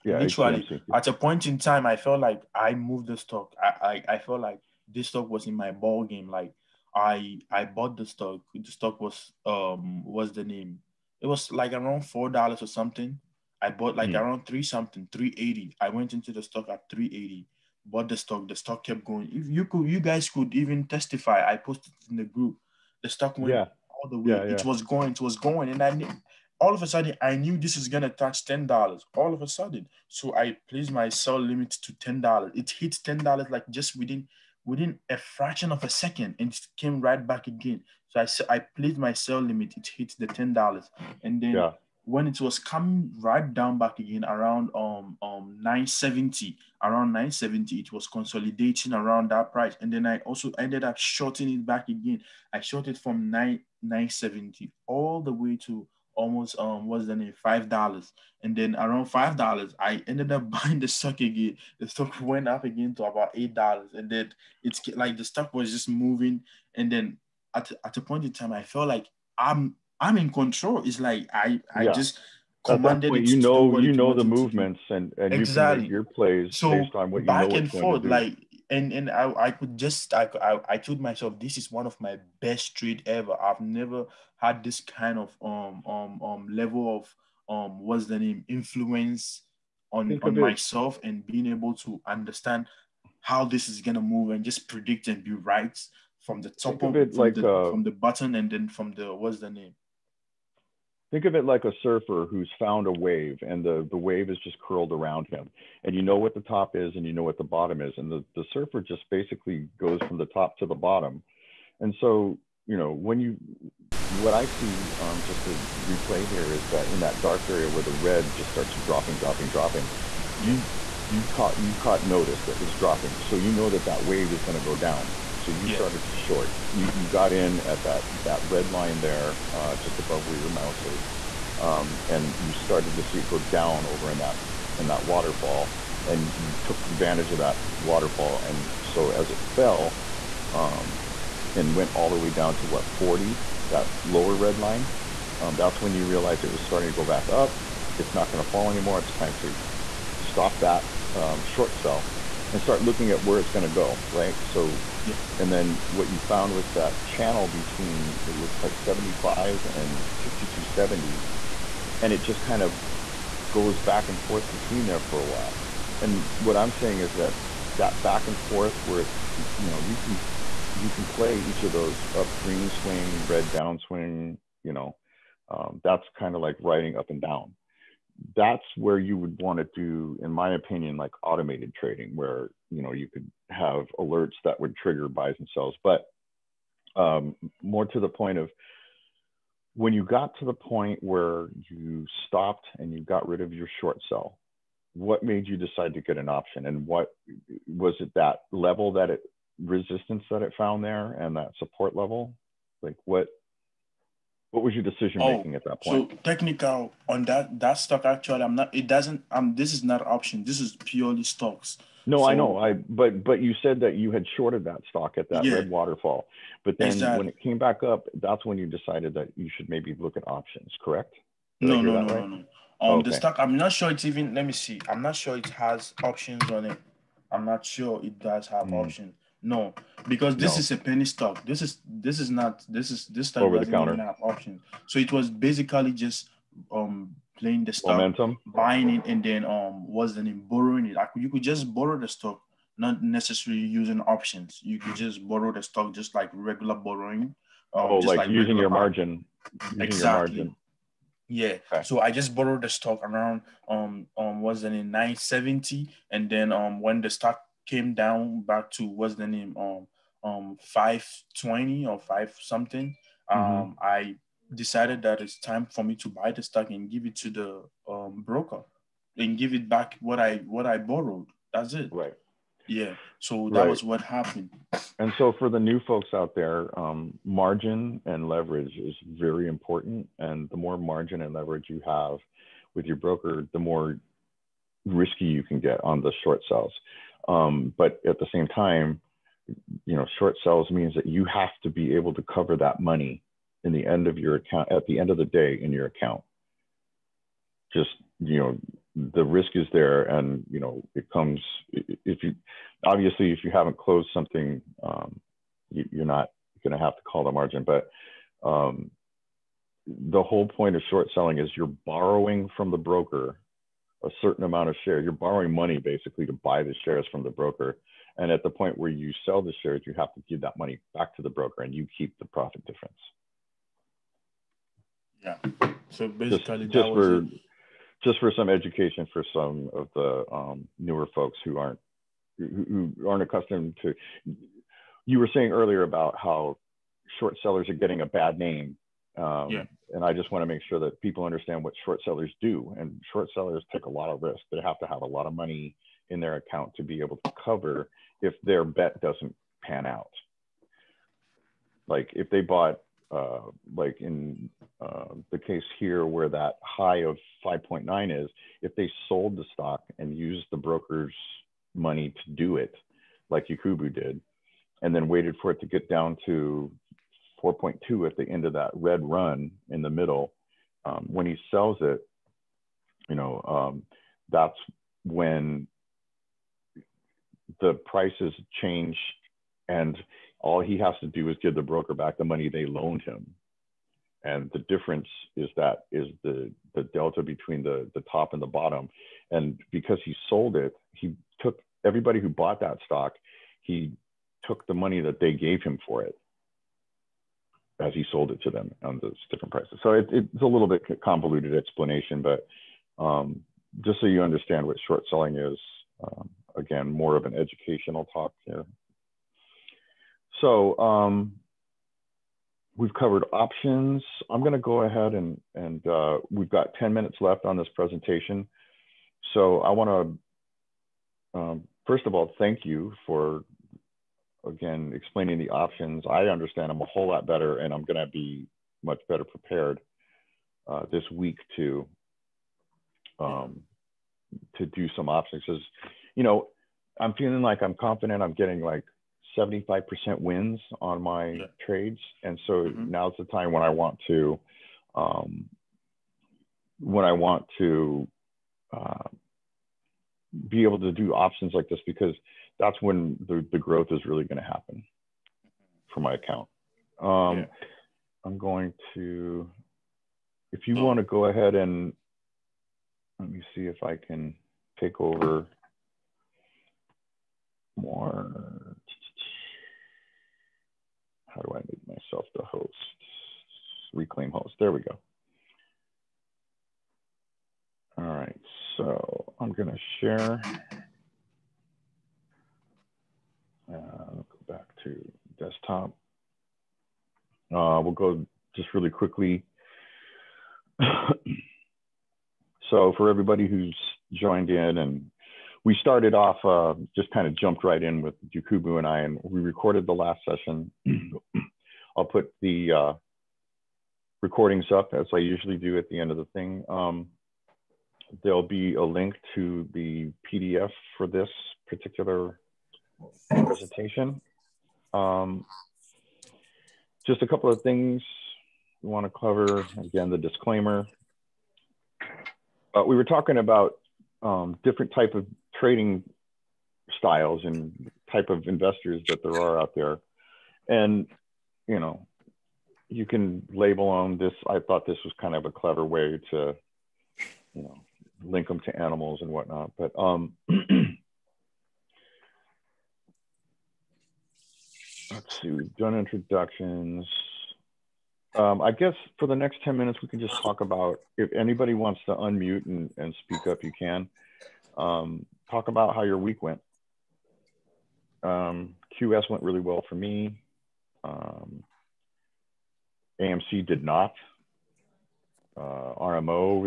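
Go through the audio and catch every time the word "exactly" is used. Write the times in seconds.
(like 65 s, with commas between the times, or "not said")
75 s, 216 s, 249 s.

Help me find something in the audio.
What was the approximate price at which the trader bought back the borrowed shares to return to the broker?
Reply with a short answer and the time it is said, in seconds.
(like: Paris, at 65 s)
520, at 260 s.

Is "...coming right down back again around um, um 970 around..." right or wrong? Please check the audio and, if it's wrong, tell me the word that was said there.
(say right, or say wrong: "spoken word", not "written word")
right.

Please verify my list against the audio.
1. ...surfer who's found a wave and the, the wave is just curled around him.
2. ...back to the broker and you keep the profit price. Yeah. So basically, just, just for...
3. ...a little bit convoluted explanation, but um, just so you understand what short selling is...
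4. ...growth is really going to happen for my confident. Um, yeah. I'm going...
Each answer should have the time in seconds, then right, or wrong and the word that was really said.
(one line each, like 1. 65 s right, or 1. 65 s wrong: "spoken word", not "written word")
1. 101 s right
2. 320 s wrong: "difference", not "price"
3. 400 s right
4. 453 s wrong: "account", not "confident".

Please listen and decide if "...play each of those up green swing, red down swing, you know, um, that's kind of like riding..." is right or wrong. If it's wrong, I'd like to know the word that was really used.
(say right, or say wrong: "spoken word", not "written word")
right.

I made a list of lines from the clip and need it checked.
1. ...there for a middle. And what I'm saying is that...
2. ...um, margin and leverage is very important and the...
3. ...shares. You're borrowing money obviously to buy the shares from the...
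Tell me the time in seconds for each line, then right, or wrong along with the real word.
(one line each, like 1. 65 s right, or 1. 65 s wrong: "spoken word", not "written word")
1. 164 s wrong: "while", not "middle"
2. 276 s right
3. 314 s wrong: "basically", not "obviously".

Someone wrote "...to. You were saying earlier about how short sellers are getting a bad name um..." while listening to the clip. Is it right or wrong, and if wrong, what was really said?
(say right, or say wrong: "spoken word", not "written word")
right.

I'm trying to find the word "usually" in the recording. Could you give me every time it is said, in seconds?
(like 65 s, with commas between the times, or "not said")
505 s.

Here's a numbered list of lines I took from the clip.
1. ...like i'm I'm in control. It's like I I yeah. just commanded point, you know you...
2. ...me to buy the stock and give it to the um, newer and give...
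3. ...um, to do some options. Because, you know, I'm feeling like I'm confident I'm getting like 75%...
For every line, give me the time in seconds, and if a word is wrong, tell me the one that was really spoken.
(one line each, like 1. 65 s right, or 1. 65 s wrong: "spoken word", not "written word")
1. 68 s right
2. 265 s wrong: "broker", not "newer"
3. 433 s right.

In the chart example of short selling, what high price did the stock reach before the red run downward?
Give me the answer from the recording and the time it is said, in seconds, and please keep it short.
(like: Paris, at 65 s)
5.9, at 357 s.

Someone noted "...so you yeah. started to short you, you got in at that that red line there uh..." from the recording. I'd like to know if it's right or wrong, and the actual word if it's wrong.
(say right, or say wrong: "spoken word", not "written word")
right.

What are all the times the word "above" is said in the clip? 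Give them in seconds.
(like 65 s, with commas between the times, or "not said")
129 s.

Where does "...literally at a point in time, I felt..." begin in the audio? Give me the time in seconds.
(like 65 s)
0 s.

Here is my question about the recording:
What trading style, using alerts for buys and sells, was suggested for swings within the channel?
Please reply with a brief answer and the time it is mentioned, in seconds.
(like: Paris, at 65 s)
automated trading, at 181 s.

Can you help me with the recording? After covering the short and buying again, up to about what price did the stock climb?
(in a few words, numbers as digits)
$8.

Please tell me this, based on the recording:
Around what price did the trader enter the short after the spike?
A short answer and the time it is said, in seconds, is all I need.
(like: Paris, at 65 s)
970, at 53 s.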